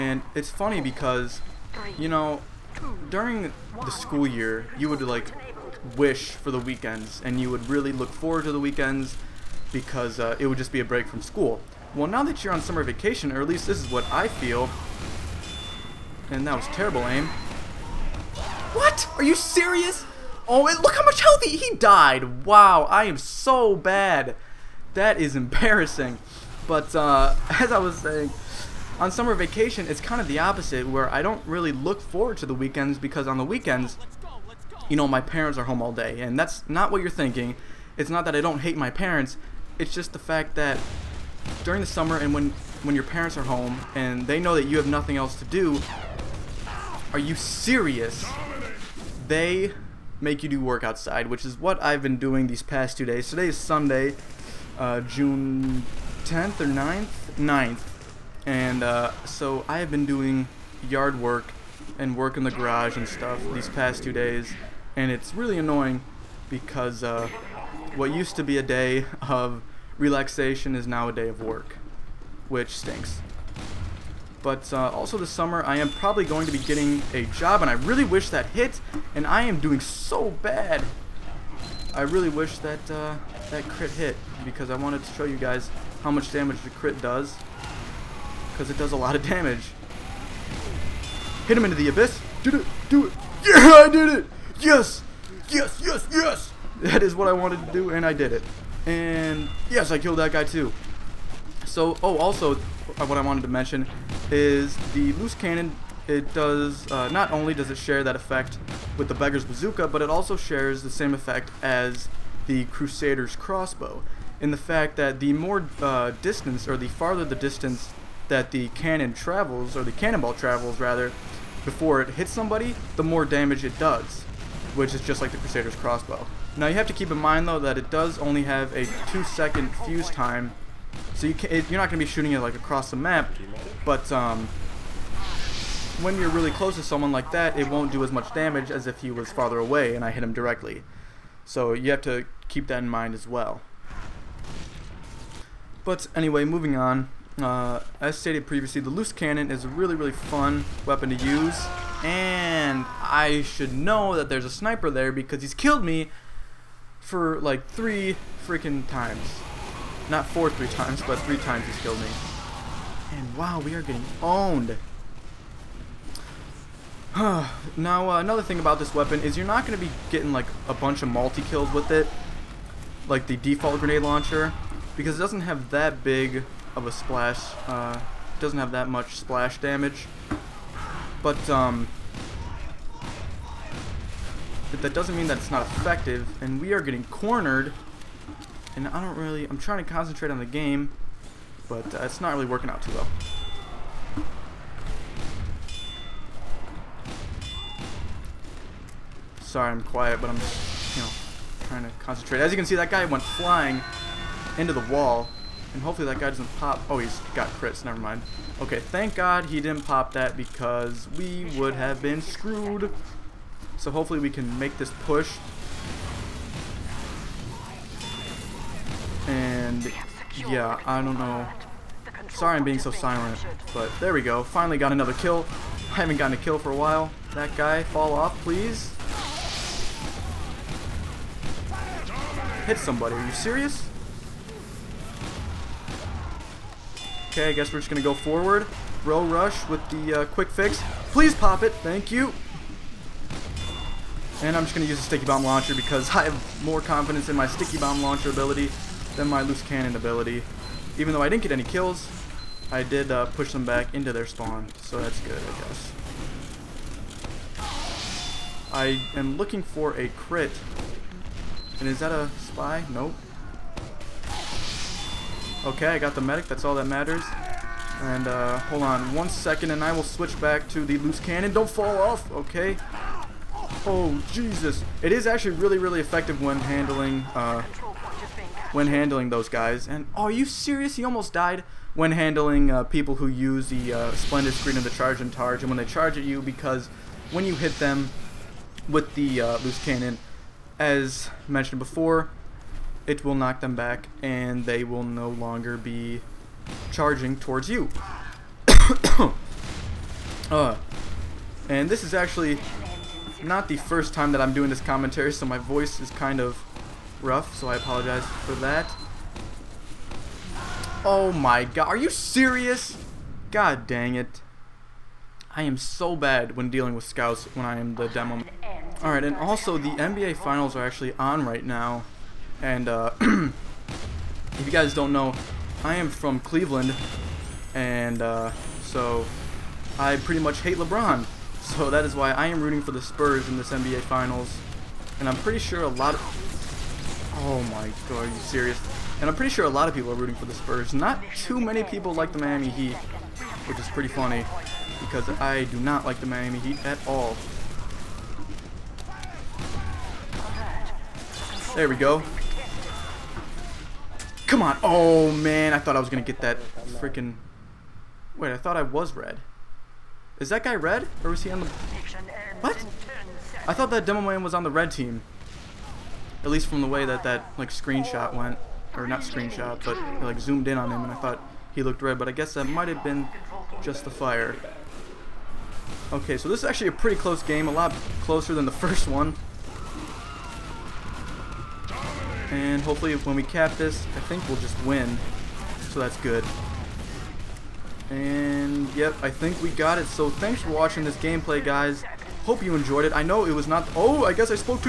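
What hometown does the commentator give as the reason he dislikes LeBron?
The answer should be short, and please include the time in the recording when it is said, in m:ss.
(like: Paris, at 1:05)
Cleveland, at 5:26.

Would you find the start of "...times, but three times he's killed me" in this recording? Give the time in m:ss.
2:40.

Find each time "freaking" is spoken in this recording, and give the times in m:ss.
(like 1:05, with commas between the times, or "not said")
2:38, 5:56.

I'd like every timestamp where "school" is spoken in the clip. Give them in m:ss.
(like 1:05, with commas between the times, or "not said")
0:03, 0:11.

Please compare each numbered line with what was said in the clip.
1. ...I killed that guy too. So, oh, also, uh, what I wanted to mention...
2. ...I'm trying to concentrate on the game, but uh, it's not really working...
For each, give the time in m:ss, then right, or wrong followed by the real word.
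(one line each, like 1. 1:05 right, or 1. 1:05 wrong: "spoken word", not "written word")
1. 1:39 right
2. 3:09 right.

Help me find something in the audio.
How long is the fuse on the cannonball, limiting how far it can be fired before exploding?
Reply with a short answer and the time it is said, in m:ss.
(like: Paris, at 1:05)
2 seconds, at 2:09.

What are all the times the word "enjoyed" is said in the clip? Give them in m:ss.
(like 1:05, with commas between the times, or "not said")
6:32.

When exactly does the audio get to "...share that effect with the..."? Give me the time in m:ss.
1:47.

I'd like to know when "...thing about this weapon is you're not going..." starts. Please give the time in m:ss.
2:48.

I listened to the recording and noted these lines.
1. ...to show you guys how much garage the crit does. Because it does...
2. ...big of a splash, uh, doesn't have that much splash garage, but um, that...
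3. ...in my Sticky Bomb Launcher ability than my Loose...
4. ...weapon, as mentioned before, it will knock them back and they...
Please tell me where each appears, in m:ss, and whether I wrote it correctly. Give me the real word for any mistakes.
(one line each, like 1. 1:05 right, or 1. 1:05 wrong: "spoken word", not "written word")
1. 1:25 wrong: "damage", not "garage"
2. 2:56 wrong: "damage", not "garage"
3. 4:07 right
4. 4:49 wrong: "cannon", not "weapon".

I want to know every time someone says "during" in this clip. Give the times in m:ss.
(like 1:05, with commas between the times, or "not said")
0:03, 0:41.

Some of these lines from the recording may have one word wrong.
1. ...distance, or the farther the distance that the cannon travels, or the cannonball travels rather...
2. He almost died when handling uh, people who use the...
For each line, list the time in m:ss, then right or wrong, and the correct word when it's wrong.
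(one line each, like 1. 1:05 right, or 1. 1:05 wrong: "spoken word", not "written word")
1. 1:56 right
2. 4:40 right.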